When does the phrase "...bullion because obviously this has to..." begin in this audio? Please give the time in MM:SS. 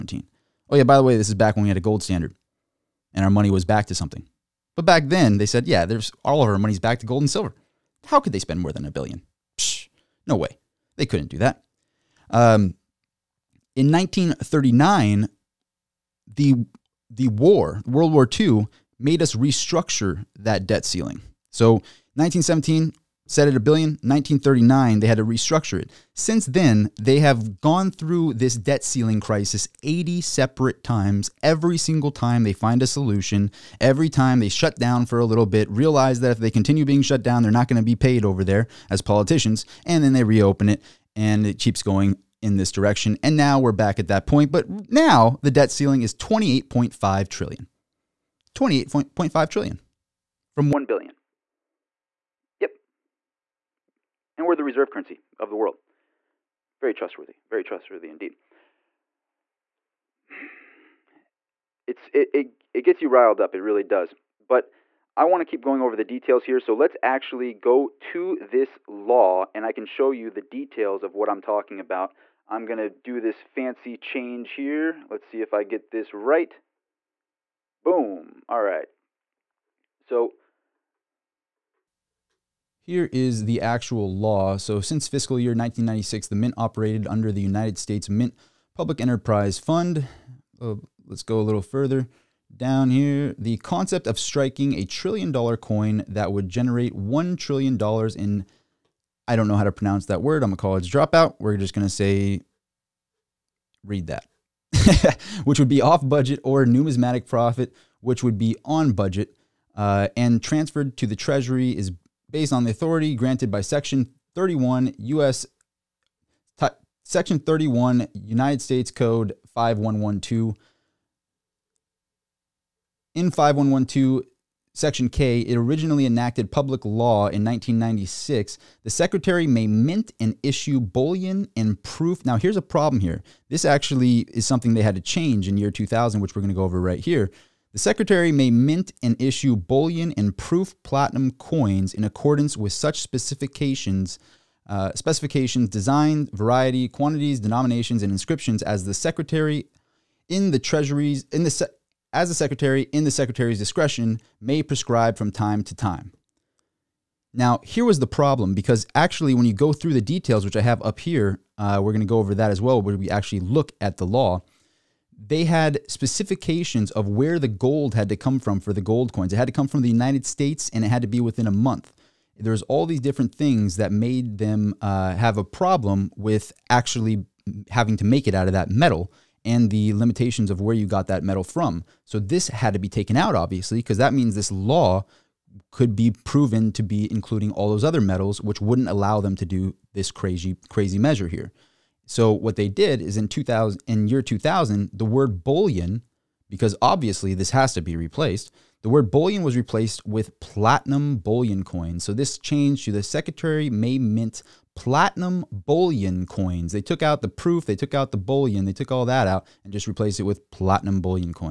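03:15.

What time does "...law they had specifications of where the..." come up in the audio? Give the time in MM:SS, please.
02:44.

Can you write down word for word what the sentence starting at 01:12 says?
I'm going to do this fancy change here.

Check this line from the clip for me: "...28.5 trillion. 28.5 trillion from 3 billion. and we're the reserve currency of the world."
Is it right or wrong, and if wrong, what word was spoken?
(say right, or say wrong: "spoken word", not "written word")
wrong: "1", not "3".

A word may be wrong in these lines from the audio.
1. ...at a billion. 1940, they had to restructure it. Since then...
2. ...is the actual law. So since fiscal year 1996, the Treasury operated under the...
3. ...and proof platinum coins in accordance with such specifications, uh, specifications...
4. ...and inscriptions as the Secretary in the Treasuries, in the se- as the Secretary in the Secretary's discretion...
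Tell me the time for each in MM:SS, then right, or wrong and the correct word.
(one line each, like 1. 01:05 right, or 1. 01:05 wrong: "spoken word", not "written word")
1. 00:23 wrong: "1939", not "1940"
2. 01:23 wrong: "Mint", not "Treasury"
3. 02:20 right
4. 02:28 right.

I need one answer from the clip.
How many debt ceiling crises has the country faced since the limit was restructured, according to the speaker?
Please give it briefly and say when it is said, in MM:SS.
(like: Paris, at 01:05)
80, at 00:29.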